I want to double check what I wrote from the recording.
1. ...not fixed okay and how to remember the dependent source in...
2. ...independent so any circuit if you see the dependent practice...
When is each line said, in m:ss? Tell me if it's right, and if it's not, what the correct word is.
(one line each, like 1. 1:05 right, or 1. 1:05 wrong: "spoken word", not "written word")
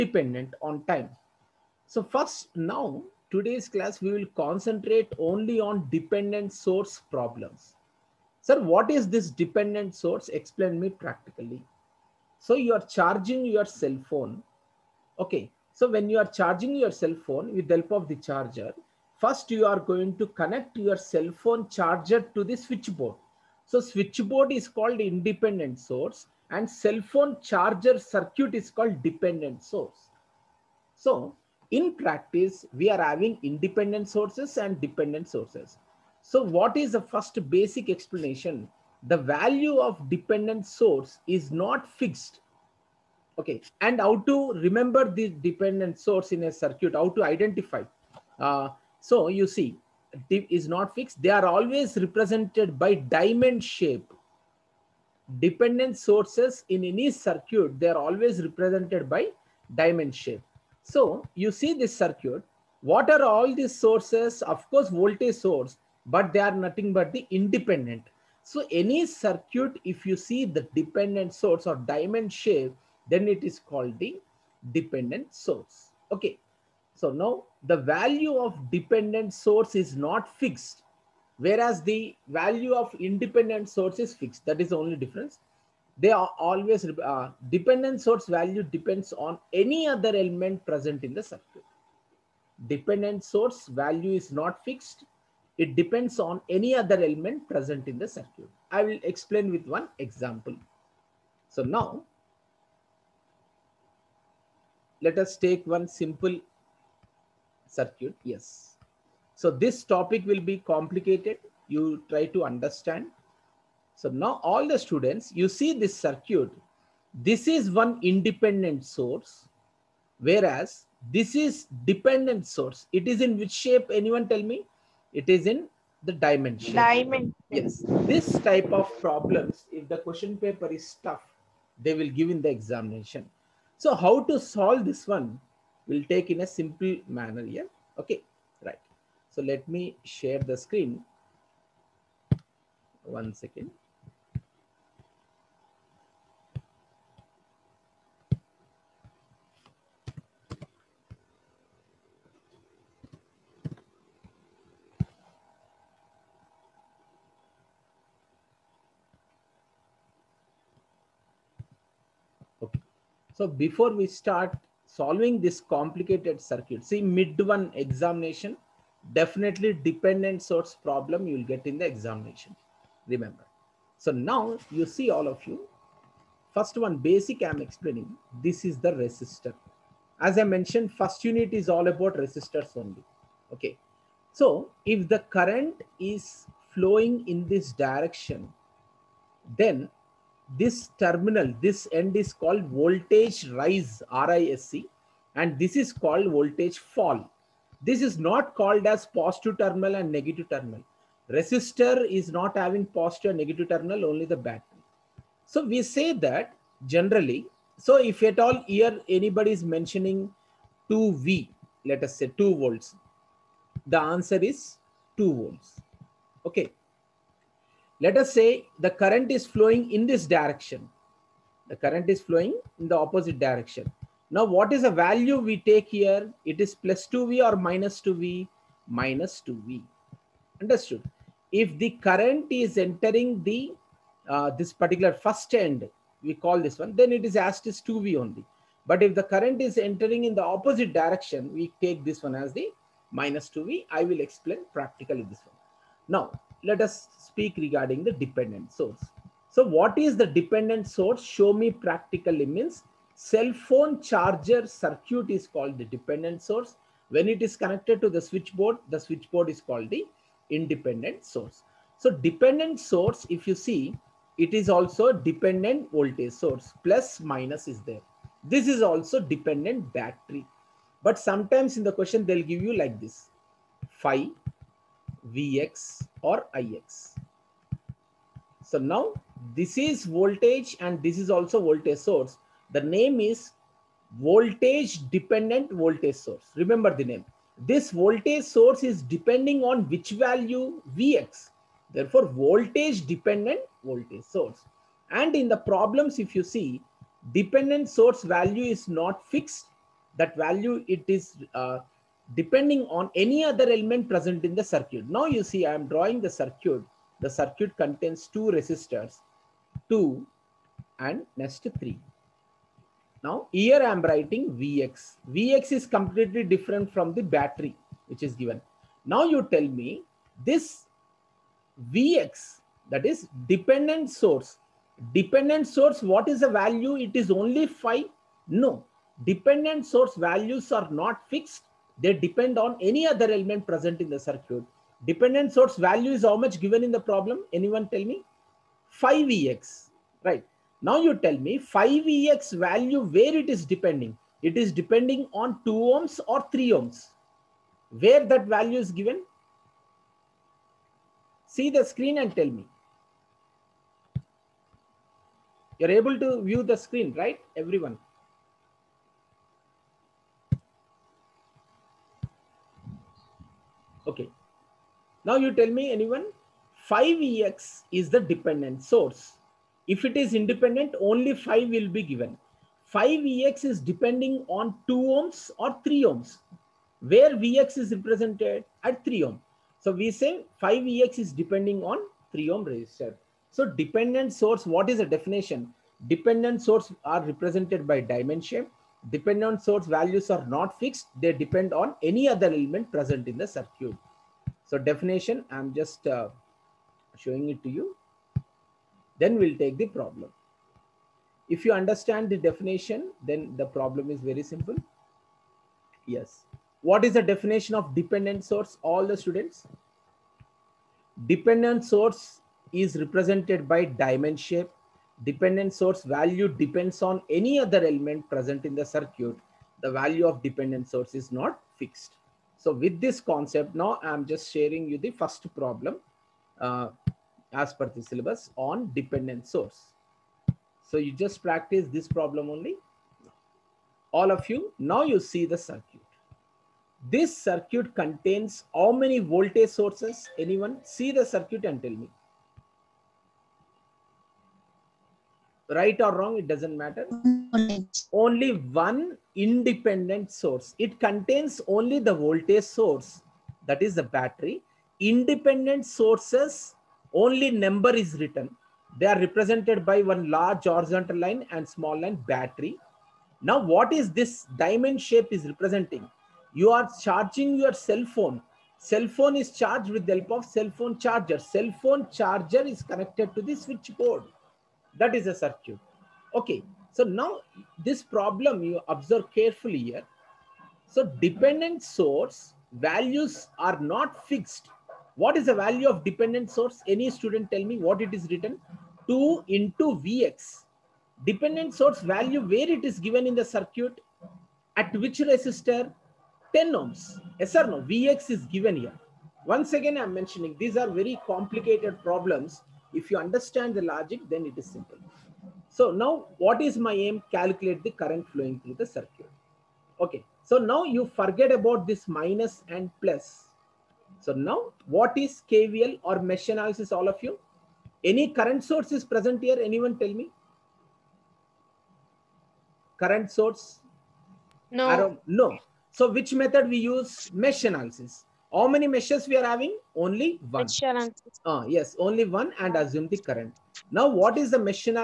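1. 0:41 right
2. 1:07 wrong: "source", not "practice".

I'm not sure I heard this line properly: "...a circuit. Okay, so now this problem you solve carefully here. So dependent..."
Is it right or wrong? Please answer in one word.
wrong.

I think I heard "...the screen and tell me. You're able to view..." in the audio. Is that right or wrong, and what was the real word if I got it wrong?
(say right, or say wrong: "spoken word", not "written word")
right.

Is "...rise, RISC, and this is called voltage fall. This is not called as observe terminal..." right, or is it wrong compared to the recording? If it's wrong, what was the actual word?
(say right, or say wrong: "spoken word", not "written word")
wrong: "positive", not "observe".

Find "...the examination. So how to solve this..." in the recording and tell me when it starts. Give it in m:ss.
2:12.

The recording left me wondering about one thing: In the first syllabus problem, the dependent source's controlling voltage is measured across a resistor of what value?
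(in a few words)
10 ohms.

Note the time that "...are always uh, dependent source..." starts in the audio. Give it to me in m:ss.
1:26.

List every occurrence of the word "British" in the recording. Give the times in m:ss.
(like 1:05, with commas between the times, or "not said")
not said.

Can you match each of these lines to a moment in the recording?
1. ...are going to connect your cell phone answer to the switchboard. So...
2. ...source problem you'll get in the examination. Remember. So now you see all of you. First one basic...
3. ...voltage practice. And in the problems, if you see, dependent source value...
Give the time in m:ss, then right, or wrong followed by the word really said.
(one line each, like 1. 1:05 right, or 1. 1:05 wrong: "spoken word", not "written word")
1. 0:19 wrong: "charger", not "answer"
2. 2:50 right
3. 4:53 wrong: "source", not "practice".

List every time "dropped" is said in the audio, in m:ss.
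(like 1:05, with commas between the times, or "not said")
not said.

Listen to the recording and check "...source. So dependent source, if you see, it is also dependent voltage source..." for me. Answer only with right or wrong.
right.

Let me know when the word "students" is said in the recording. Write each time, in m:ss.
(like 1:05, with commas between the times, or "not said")
1:54, 6:49, 8:07.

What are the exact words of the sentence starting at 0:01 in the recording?
So first now today's class, we will concentrate only on dependent source problems.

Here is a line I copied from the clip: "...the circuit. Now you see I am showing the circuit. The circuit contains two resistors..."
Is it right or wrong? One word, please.
wrong.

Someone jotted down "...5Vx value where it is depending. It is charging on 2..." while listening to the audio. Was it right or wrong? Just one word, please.
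wrong.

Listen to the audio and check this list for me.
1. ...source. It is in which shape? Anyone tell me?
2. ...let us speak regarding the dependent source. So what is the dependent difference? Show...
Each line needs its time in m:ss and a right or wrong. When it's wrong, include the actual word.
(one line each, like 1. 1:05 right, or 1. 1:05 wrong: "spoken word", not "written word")
1. 2:02 right
2. 4:06 wrong: "source", not "difference".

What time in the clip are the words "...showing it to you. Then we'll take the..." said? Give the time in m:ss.
6:37.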